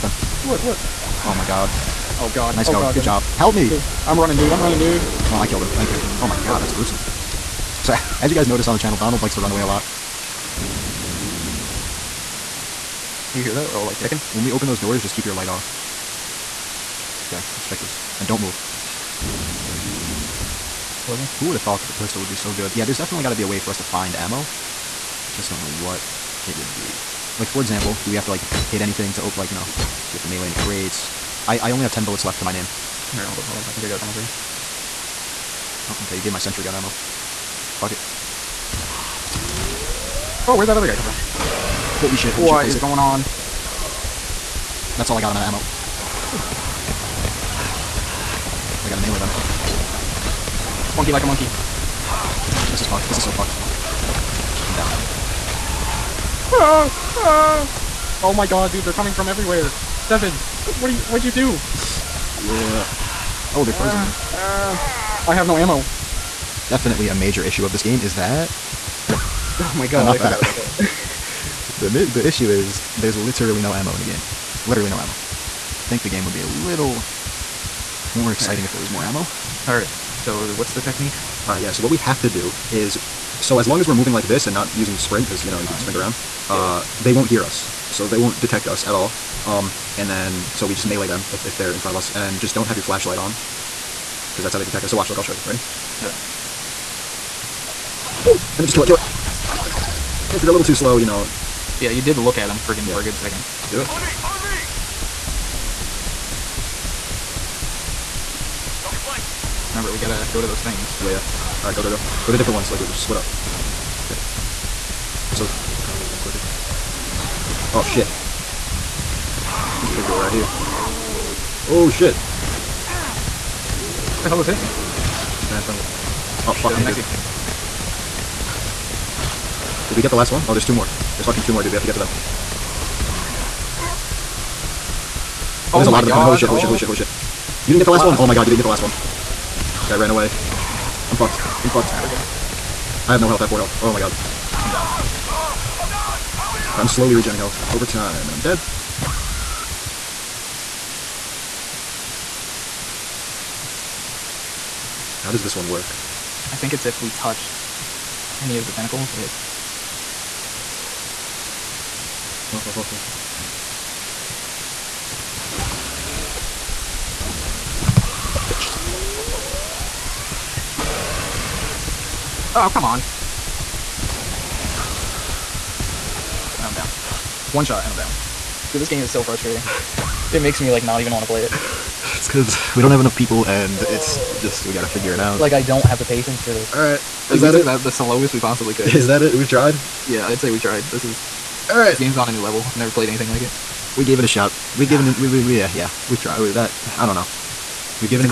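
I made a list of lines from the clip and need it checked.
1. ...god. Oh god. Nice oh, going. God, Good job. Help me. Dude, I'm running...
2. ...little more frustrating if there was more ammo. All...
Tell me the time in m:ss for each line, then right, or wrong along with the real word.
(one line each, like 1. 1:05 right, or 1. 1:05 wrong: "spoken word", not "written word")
1. 0:01 right
2. 1:16 wrong: "exciting", not "frustrating".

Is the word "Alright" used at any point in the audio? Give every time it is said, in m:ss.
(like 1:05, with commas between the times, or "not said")
0:33, 1:51.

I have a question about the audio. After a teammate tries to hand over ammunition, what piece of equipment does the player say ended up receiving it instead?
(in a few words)
sentry gun.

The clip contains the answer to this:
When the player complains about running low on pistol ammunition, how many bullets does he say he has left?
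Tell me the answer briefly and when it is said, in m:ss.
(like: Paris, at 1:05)
10, at 0:31.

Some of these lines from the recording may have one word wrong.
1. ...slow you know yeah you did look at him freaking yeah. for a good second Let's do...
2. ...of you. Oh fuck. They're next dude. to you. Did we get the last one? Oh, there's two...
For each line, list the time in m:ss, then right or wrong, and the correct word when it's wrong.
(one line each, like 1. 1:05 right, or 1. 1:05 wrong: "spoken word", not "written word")
1. 1:40 right
2. 2:05 right.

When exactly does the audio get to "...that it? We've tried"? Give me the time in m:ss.
3:09.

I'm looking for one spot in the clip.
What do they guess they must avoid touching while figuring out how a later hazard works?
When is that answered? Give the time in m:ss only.
2:38.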